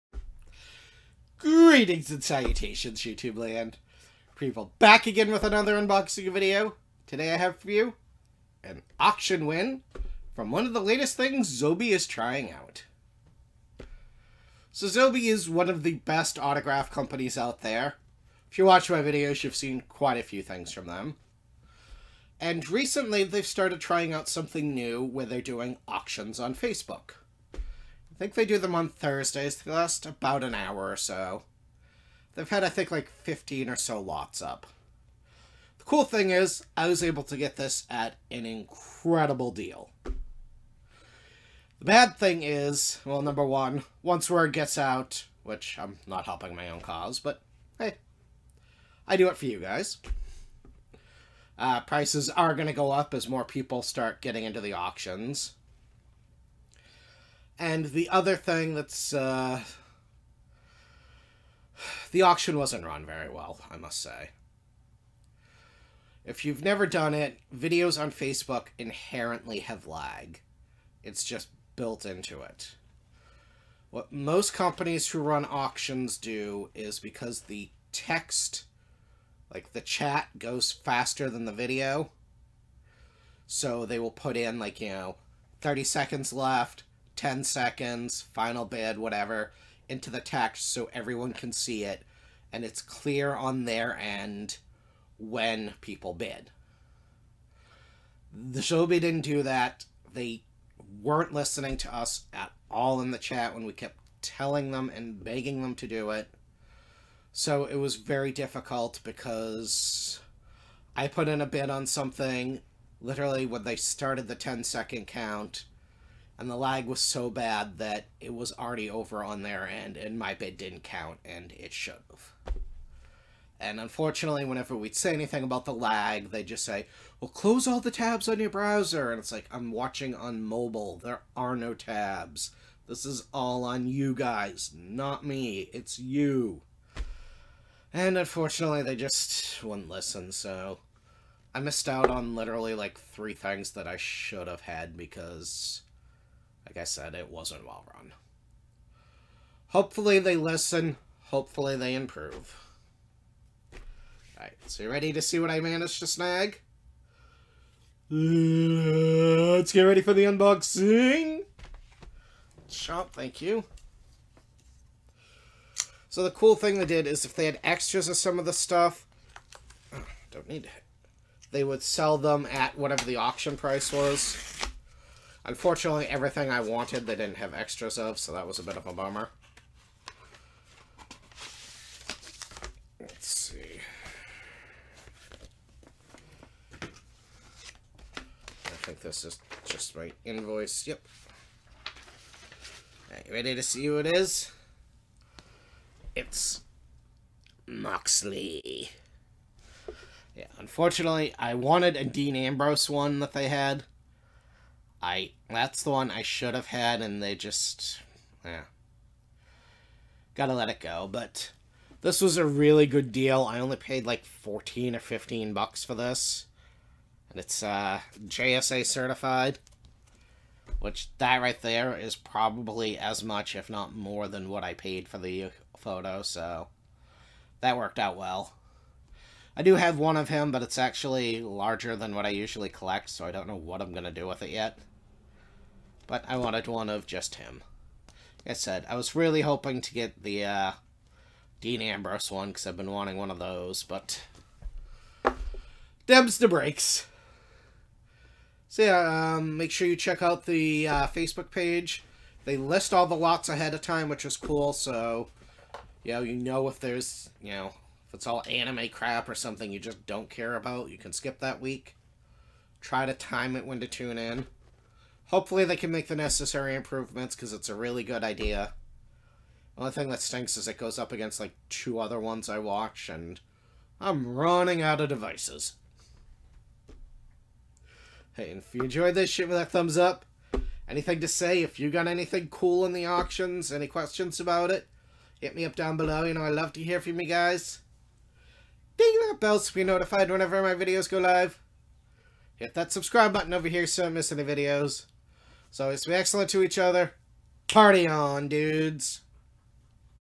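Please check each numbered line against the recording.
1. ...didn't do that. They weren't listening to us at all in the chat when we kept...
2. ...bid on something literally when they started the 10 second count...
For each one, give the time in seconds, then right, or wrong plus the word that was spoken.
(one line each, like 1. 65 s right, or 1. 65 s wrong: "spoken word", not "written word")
1. 98 s right
2. 111 s right.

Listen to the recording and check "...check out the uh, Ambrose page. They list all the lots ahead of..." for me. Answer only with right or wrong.
wrong.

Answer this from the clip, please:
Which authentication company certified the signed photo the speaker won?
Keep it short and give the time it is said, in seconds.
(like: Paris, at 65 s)
JSA, at 218 s.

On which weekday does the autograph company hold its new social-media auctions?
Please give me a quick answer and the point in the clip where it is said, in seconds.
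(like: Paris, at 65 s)
Thursdays, at 28 s.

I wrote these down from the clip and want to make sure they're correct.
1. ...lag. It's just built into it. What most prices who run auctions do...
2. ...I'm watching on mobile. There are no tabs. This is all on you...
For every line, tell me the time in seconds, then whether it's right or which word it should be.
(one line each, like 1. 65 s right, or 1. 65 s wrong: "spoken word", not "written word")
1. 69 s wrong: "companies", not "prices"
2. 129 s right.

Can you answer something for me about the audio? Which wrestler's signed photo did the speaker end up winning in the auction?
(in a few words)
Moxley.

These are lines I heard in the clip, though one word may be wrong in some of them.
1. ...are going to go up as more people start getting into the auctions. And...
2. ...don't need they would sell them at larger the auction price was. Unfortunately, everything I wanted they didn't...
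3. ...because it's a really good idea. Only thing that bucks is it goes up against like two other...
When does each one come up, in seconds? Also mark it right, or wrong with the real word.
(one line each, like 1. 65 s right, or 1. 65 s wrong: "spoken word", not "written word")
1. 52 s right
2. 170 s wrong: "whatever", not "larger"
3. 267 s wrong: "stinks", not "bucks".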